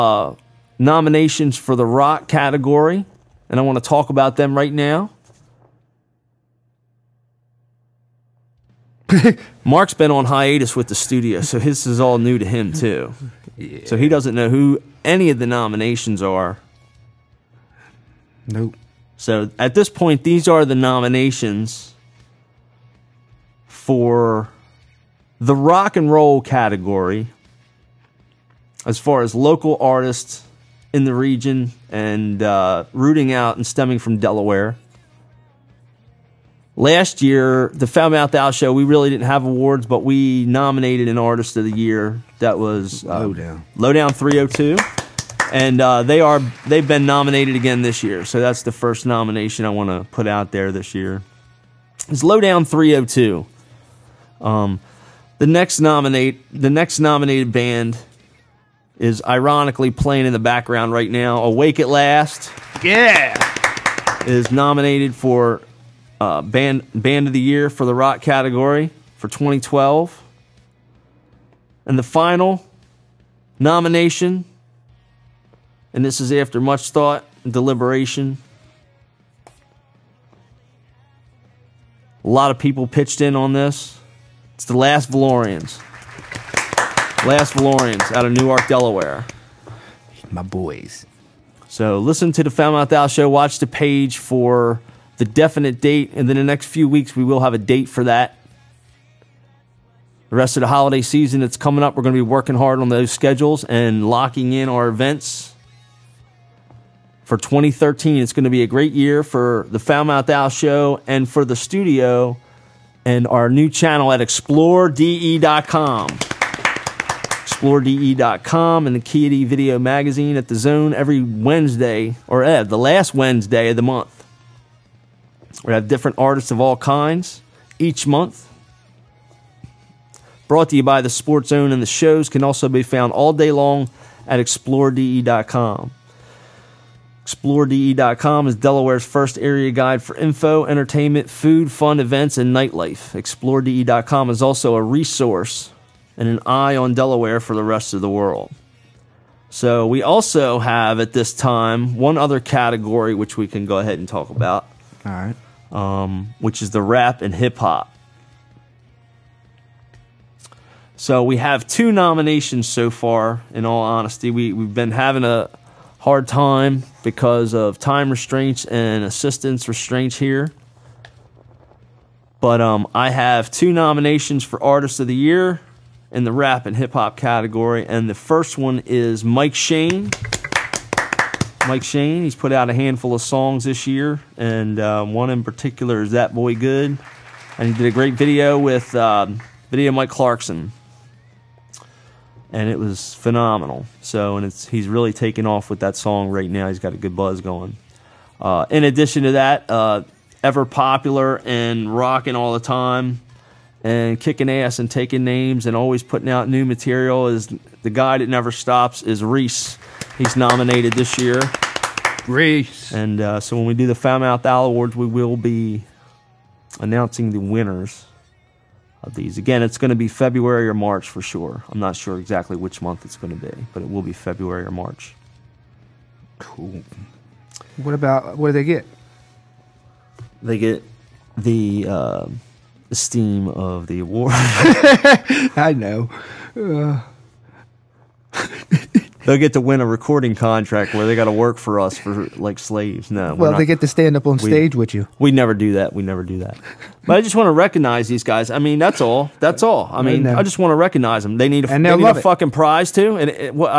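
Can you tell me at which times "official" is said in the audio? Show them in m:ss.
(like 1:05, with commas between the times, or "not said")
not said.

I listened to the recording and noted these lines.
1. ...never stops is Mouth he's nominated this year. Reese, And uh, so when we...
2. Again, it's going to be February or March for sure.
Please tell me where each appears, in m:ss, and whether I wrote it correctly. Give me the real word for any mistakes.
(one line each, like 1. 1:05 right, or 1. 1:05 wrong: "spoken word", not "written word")
1. 3:28 wrong: "Reese", not "Mouth"
2. 3:39 right.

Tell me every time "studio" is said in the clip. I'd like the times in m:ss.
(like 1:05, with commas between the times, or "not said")
0:10, 1:51.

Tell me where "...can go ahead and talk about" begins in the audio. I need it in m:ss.
2:33.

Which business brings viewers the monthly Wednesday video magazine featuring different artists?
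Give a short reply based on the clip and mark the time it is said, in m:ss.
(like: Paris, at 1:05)
The Sports Zone, at 2:11.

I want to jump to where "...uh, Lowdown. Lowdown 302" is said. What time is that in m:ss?
0:43.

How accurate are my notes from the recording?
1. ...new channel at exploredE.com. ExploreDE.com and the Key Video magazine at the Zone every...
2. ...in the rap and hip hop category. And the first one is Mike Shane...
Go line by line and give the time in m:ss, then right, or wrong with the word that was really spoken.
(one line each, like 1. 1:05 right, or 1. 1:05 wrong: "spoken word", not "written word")
1. 1:53 right
2. 2:56 right.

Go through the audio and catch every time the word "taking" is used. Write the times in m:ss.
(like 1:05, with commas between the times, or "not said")
3:24.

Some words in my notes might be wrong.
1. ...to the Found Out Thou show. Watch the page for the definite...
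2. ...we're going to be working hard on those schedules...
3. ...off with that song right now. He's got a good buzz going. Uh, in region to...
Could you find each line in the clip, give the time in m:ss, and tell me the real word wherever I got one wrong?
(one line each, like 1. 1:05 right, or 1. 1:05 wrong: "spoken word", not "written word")
1. 1:32 right
2. 1:41 right
3. 3:15 wrong: "addition", not "region".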